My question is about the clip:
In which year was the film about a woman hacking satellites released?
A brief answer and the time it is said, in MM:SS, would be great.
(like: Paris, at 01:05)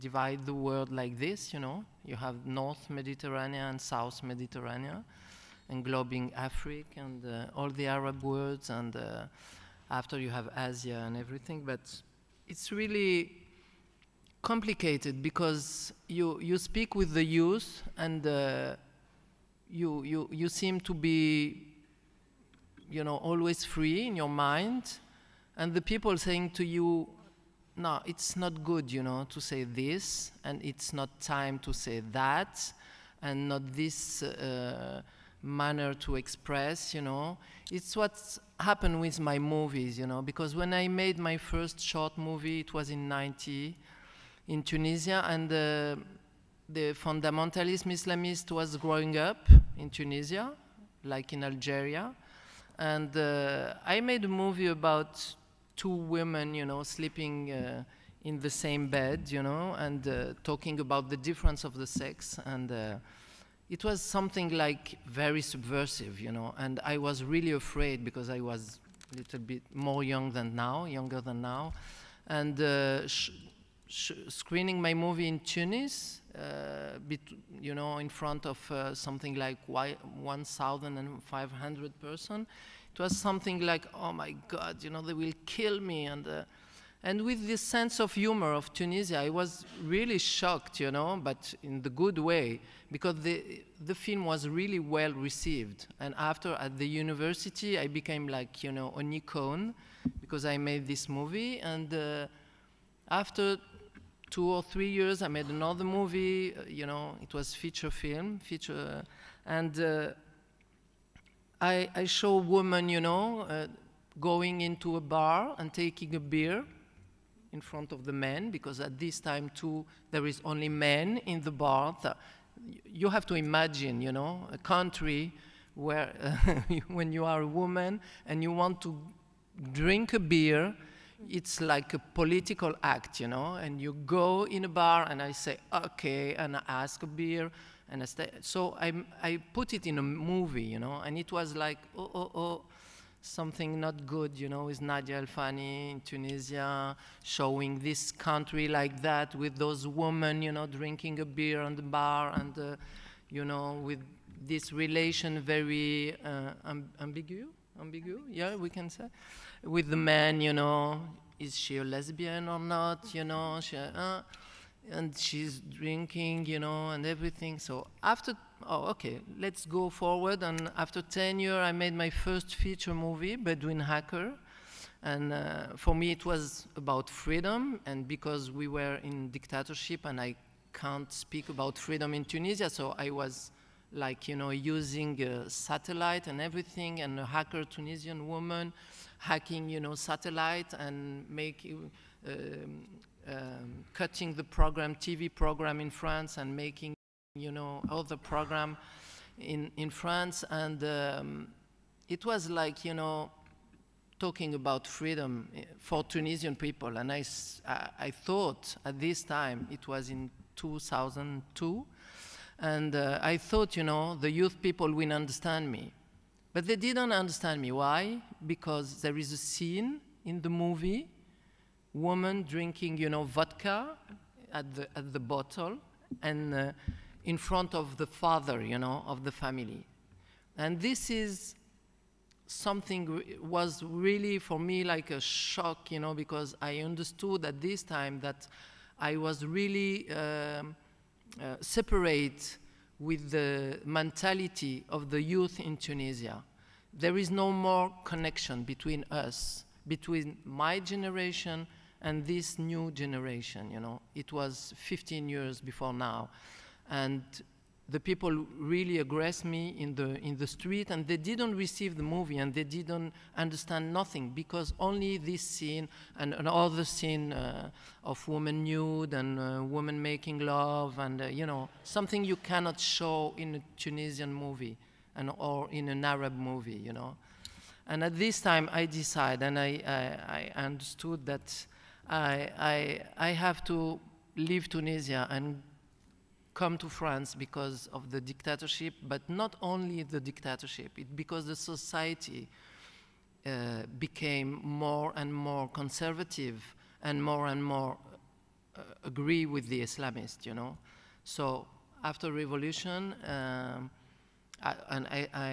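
2002, at 03:30.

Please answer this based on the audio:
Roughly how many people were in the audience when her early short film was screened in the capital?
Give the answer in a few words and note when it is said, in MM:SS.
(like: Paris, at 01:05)
1,500, at 01:19.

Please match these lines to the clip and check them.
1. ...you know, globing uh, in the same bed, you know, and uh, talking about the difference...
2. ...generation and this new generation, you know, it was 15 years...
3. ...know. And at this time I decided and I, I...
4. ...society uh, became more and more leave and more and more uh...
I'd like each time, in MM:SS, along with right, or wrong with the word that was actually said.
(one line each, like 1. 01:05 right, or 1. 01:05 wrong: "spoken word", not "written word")
1. 00:56 wrong: "sleeping", not "globing"
2. 04:10 right
3. 04:36 right
4. 04:51 wrong: "conservative", not "leave".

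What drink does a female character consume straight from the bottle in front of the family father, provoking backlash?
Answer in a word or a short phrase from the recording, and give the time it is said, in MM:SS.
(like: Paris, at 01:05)
Vodka, at 03:43.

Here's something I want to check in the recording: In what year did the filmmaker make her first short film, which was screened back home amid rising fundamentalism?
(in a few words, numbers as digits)
1990.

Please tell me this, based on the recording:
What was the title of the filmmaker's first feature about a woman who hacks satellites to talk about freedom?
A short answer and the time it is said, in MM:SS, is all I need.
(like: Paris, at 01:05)
Bedouin Hacker, at 02:53.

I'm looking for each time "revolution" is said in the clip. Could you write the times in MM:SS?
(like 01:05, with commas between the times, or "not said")
05:02.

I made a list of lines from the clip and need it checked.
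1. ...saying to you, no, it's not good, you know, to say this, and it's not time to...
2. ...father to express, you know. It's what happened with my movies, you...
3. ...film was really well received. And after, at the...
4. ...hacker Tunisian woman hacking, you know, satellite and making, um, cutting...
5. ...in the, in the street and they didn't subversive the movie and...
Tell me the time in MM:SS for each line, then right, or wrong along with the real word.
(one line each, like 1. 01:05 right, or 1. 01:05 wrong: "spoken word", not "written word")
1. 00:26 right
2. 00:35 wrong: "manner", not "father"
3. 01:33 right
4. 03:07 right
5. 04:19 wrong: "receive", not "subversive".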